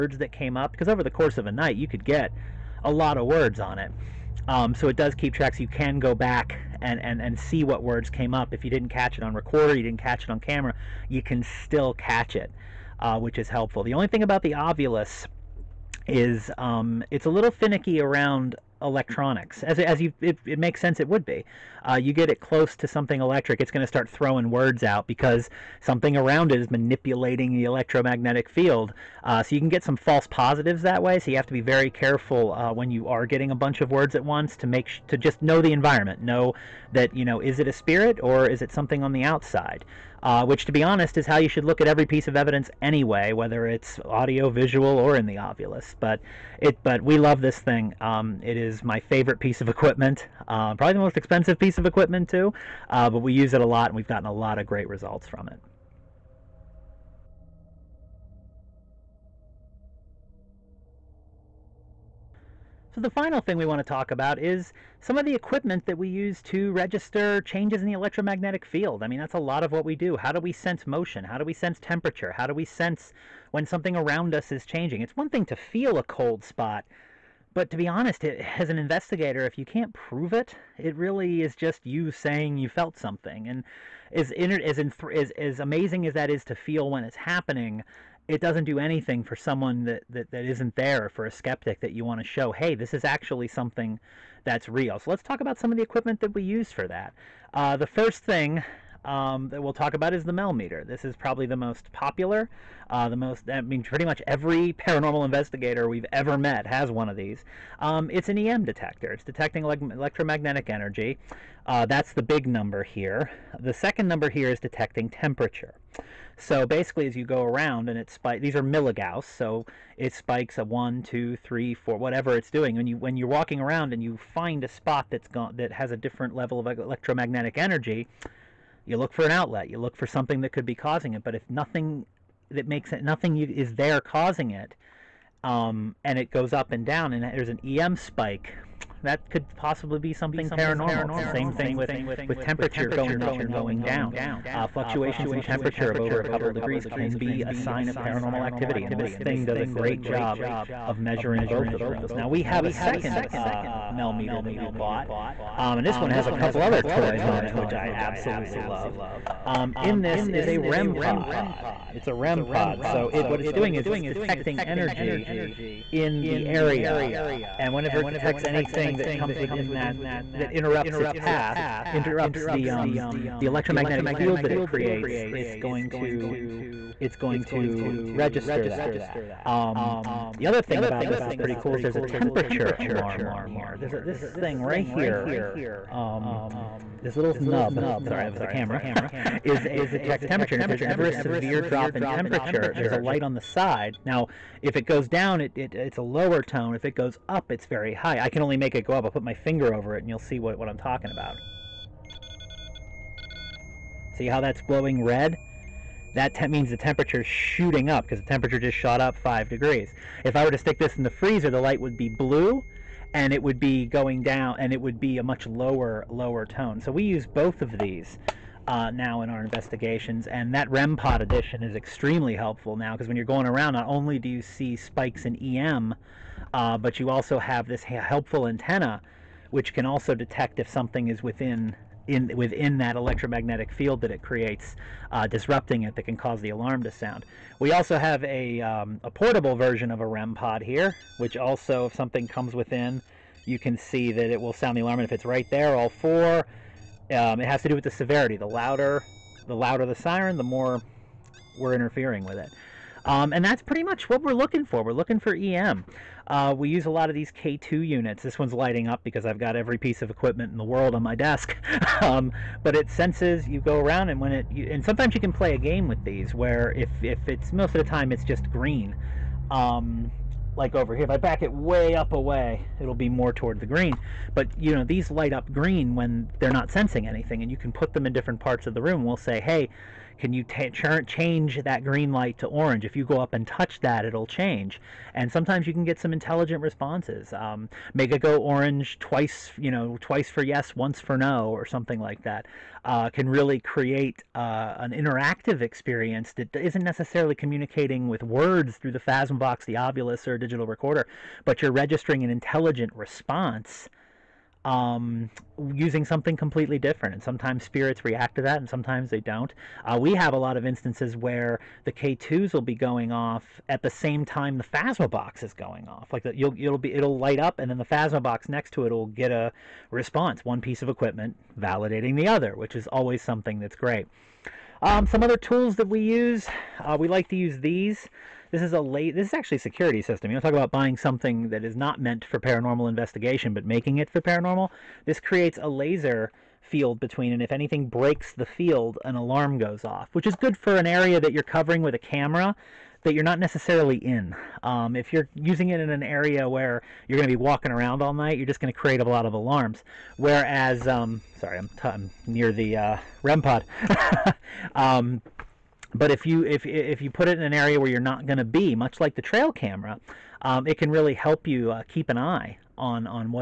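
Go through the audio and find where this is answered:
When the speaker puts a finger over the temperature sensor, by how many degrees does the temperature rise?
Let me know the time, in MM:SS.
03:29.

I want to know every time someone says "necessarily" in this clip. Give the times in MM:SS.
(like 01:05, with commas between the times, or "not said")
04:56, 05:43.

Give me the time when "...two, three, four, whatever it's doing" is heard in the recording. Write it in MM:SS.
02:01.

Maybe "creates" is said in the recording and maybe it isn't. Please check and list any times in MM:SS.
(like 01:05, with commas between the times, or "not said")
02:54, 03:54, 04:53, 05:35, 05:48.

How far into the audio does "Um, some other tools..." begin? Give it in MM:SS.
05:24.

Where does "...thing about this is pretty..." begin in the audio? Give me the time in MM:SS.
03:00.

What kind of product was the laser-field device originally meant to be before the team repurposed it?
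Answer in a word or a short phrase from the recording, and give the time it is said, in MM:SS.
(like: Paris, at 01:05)
security system, at 05:29.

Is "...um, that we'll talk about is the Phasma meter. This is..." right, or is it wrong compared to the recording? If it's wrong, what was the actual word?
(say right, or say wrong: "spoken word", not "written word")
wrong: "MEL", not "Phasma".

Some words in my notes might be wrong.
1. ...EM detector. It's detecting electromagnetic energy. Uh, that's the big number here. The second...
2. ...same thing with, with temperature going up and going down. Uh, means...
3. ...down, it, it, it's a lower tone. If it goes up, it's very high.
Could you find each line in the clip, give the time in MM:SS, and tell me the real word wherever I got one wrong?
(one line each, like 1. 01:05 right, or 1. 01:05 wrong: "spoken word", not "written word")
1. 01:48 right
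2. 02:21 wrong: "fluctuations", not "means"
3. 03:15 right.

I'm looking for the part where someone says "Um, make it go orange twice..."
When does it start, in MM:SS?
04:47.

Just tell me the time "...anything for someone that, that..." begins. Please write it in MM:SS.
01:28.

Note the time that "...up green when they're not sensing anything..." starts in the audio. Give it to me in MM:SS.
04:35.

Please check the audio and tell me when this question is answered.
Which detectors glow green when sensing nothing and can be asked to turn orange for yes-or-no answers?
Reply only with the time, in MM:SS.
04:17.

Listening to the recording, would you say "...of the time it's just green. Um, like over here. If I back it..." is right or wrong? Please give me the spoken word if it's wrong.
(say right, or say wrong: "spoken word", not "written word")
right.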